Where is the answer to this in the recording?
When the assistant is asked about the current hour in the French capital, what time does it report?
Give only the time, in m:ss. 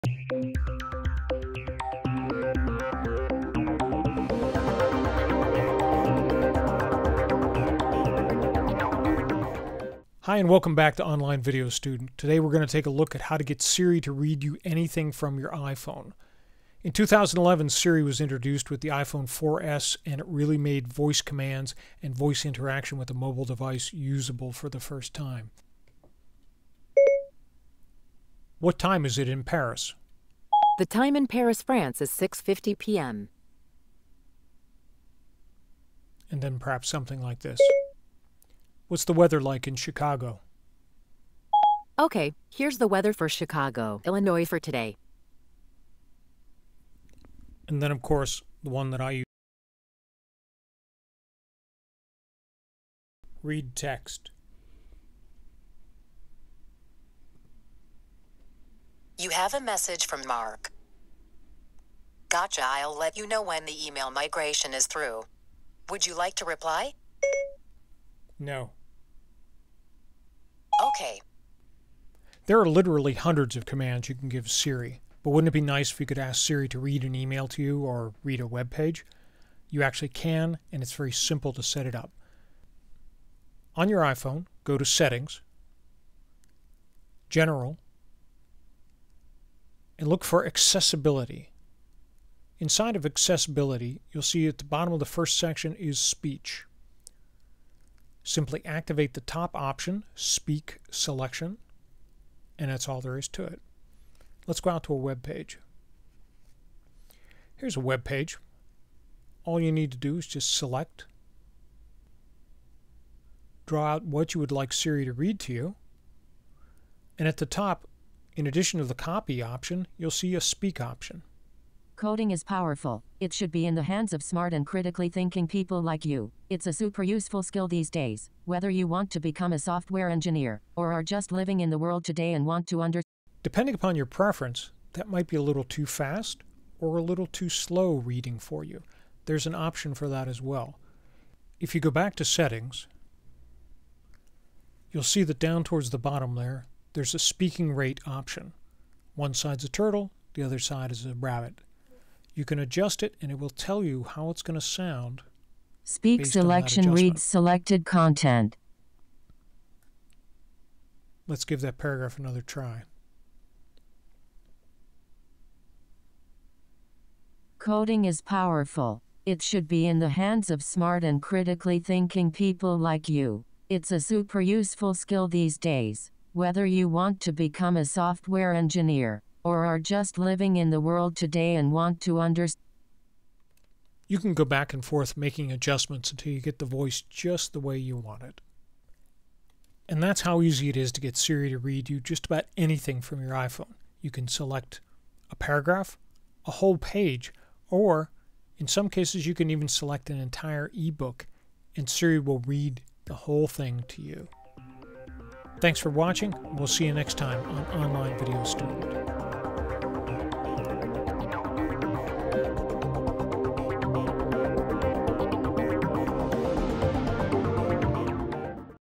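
0:32.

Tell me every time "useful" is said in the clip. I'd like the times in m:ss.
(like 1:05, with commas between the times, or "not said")
2:07, 2:54.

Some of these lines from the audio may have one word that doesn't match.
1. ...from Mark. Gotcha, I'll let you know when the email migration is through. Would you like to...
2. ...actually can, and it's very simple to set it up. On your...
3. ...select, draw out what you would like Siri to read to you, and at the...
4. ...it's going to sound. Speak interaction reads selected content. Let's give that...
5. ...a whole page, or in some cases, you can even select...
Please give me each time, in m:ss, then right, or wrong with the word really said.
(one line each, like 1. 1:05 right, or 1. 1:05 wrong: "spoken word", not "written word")
1. 1:00 right
2. 1:19 right
3. 1:50 right
4. 2:34 wrong: "selection", not "interaction"
5. 3:16 right.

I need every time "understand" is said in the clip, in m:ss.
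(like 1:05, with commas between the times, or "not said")
2:12, 3:02.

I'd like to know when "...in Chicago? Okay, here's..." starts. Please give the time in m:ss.
0:39.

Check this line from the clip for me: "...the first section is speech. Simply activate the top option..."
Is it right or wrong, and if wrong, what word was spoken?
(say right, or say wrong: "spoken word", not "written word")
right.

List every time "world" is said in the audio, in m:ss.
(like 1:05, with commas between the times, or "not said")
2:11, 3:00.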